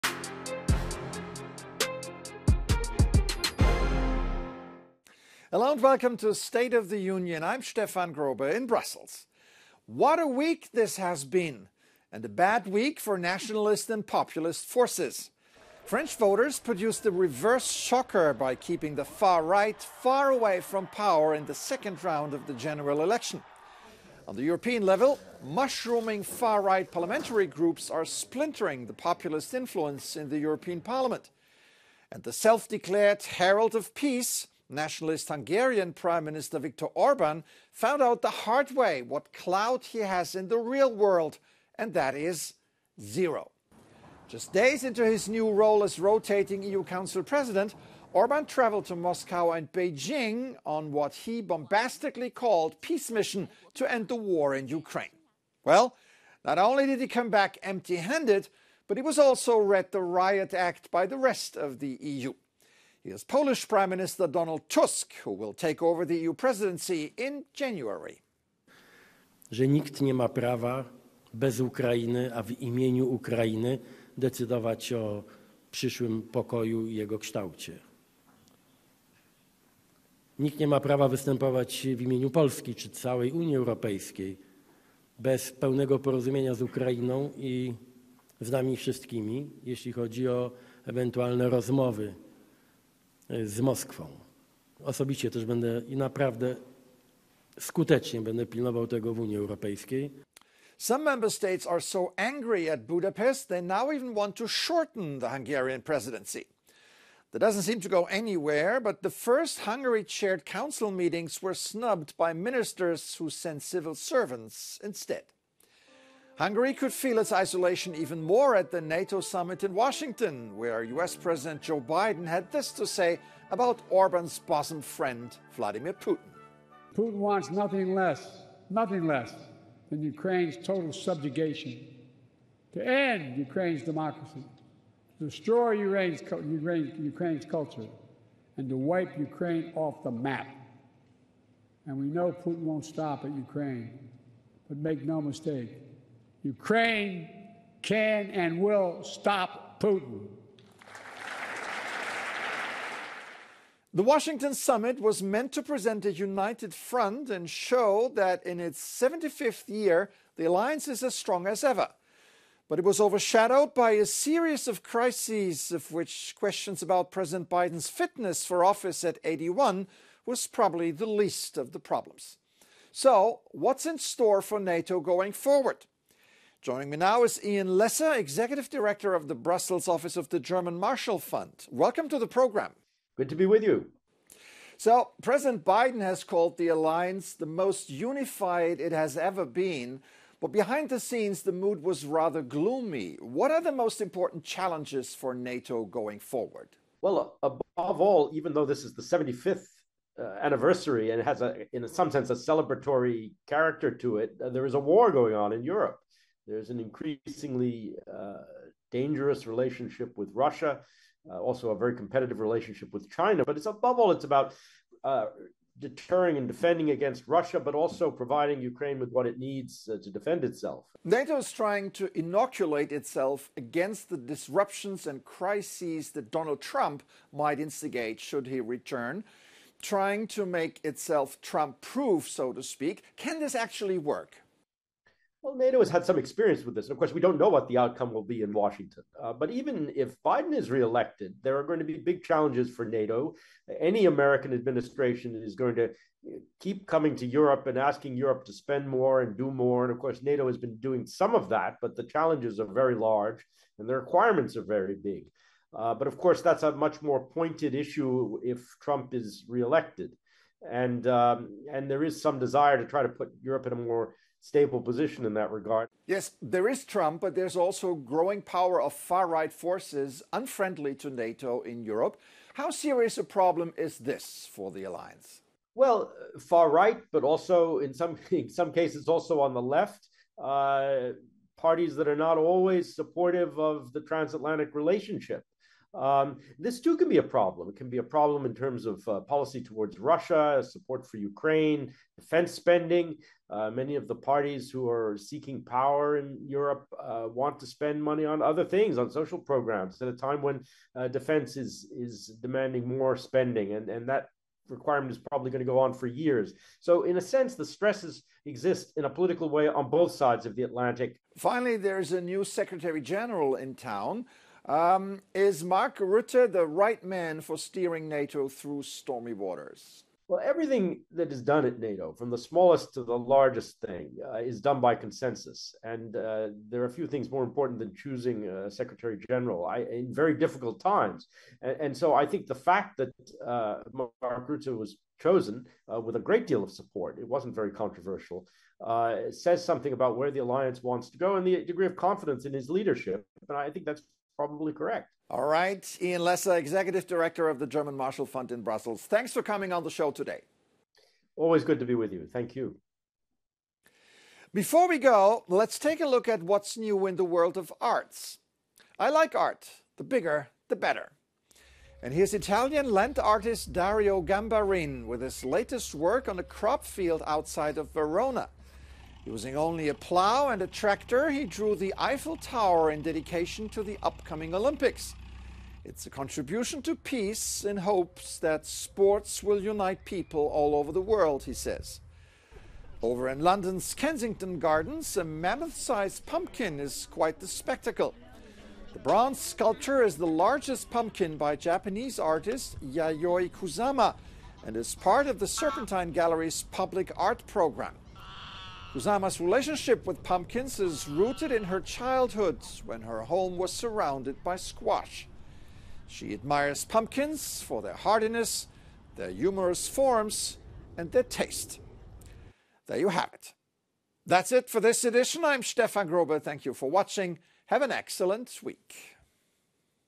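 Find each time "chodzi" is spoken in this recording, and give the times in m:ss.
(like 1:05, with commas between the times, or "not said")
1:29.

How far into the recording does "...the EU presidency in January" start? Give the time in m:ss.
1:06.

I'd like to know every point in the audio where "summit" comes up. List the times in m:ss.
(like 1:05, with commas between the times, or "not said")
1:59, 2:34.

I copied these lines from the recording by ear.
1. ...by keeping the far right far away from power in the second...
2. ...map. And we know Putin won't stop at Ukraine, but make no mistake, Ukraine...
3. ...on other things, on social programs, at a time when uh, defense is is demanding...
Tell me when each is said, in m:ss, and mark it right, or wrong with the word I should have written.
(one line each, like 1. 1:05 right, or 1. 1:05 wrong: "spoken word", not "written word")
1. 0:18 right
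2. 2:20 right
3. 4:58 right.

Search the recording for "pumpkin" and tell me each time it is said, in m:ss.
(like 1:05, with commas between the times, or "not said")
6:26, 6:30, 6:40, 6:46.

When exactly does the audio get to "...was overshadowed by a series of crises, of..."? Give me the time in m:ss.
2:42.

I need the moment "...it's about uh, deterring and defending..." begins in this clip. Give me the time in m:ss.
3:34.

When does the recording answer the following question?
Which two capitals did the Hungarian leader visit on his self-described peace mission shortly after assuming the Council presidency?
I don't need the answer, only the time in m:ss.
0:48.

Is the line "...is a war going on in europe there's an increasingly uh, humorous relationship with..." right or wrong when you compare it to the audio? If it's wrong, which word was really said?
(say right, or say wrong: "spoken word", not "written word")
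wrong: "dangerous", not "humorous".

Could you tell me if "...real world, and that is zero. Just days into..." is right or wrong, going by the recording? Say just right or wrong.
right.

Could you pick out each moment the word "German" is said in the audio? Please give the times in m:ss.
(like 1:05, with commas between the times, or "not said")
3:00, 5:47.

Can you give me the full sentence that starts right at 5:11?
Finally, there's a new Secretary General in town.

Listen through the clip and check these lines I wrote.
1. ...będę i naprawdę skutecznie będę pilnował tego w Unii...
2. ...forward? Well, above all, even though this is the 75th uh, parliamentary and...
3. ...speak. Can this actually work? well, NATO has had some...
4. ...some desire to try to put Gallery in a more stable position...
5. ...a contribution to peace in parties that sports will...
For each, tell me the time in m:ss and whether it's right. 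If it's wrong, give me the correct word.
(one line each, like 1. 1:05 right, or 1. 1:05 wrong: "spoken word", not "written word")
1. 1:35 right
2. 3:16 wrong: "anniversary", not "parliamentary"
3. 3:52 right
4. 4:22 wrong: "Europe", not "Gallery"
5. 6:16 wrong: "hopes", not "parties".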